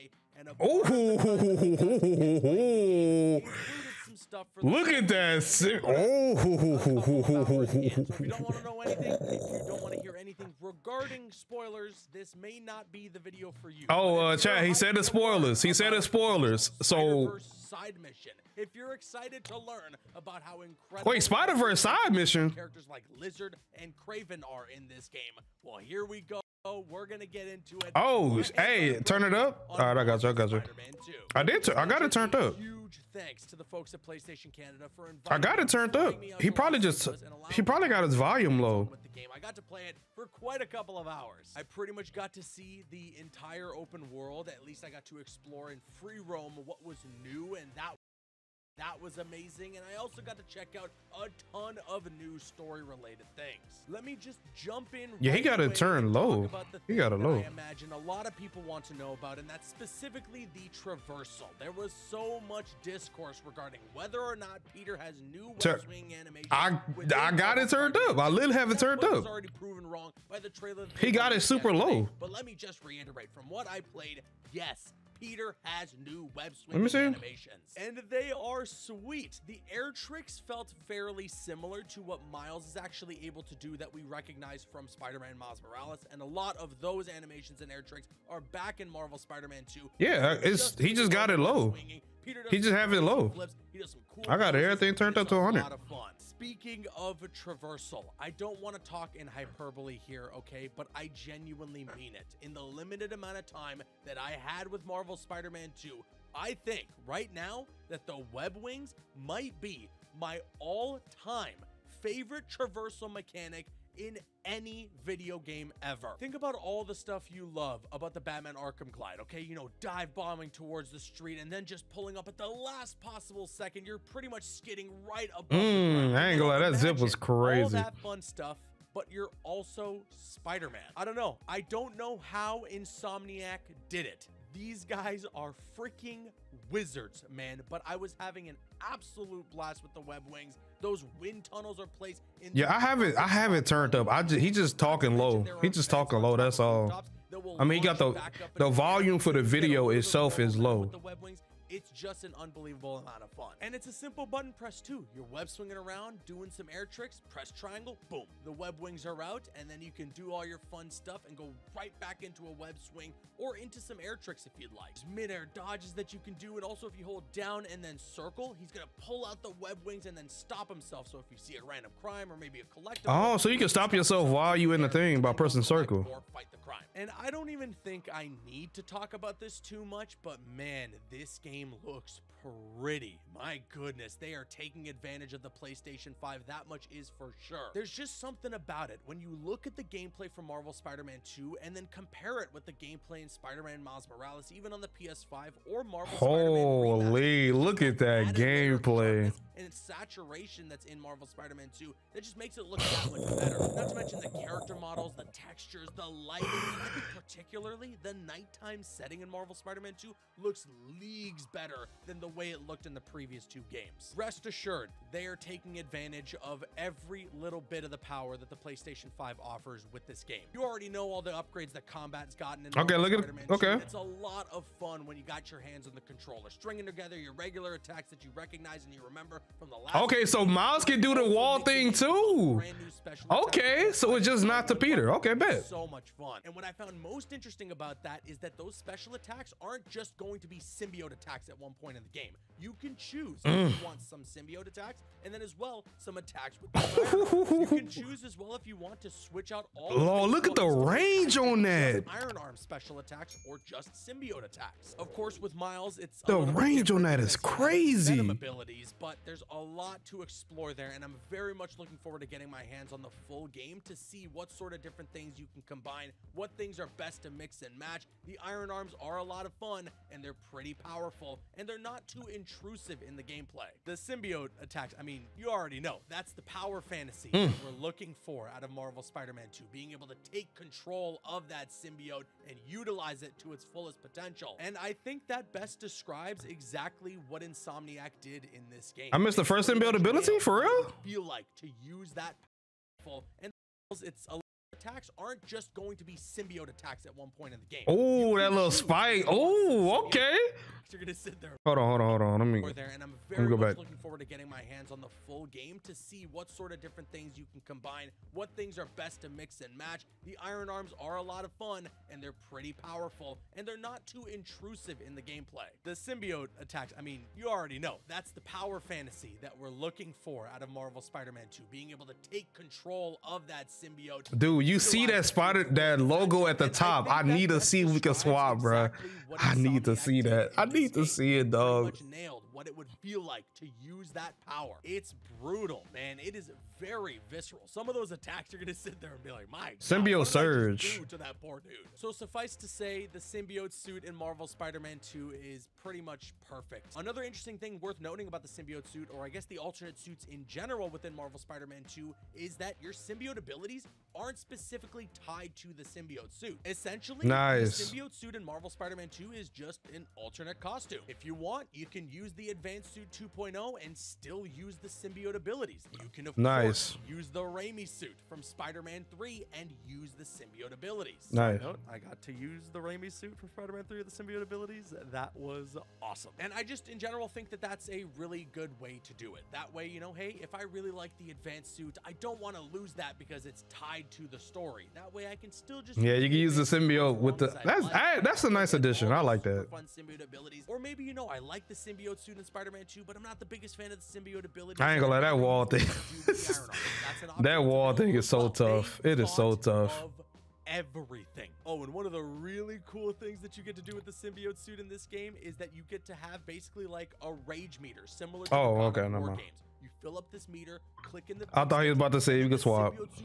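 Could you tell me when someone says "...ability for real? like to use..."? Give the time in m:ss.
4:49.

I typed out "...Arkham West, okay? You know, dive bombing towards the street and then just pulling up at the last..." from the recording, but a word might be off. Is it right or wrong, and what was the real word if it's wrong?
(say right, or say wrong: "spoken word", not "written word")
wrong: "Glide", not "West".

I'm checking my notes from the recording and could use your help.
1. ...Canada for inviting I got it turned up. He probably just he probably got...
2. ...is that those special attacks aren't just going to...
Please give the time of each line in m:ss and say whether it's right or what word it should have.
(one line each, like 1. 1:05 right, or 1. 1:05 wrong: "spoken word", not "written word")
1. 0:34 right
2. 3:58 right.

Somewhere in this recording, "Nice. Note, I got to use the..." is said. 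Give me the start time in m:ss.
6:11.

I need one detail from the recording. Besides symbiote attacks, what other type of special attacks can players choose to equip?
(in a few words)
Iron arm.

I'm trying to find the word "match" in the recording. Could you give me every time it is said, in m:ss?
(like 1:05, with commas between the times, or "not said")
4:27, 5:09.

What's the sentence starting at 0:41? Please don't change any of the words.
I pretty much got to see the entire open world.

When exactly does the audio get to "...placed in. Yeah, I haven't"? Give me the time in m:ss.
2:21.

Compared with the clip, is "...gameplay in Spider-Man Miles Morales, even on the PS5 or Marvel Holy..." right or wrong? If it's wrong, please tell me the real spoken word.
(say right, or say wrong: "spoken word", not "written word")
right.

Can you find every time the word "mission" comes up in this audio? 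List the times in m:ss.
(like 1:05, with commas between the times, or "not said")
0:18, 0:22.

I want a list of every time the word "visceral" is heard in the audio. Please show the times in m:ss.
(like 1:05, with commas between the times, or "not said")
5:37.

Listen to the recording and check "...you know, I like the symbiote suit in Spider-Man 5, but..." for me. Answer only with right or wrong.
wrong.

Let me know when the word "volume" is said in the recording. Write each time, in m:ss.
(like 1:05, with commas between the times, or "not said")
0:38, 2:28.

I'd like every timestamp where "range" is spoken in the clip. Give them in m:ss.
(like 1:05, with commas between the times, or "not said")
4:10, 4:16.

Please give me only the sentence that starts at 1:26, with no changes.
And a lot of those animations and air tricks are back in Marvel Spider-Man 2.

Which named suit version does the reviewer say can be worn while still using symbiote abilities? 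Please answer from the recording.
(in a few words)
Advanced Suit 2.0.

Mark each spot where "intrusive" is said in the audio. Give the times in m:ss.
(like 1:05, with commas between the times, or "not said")
4:32, 5:14.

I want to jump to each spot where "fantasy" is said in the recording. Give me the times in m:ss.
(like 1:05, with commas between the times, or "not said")
4:36, 5:18.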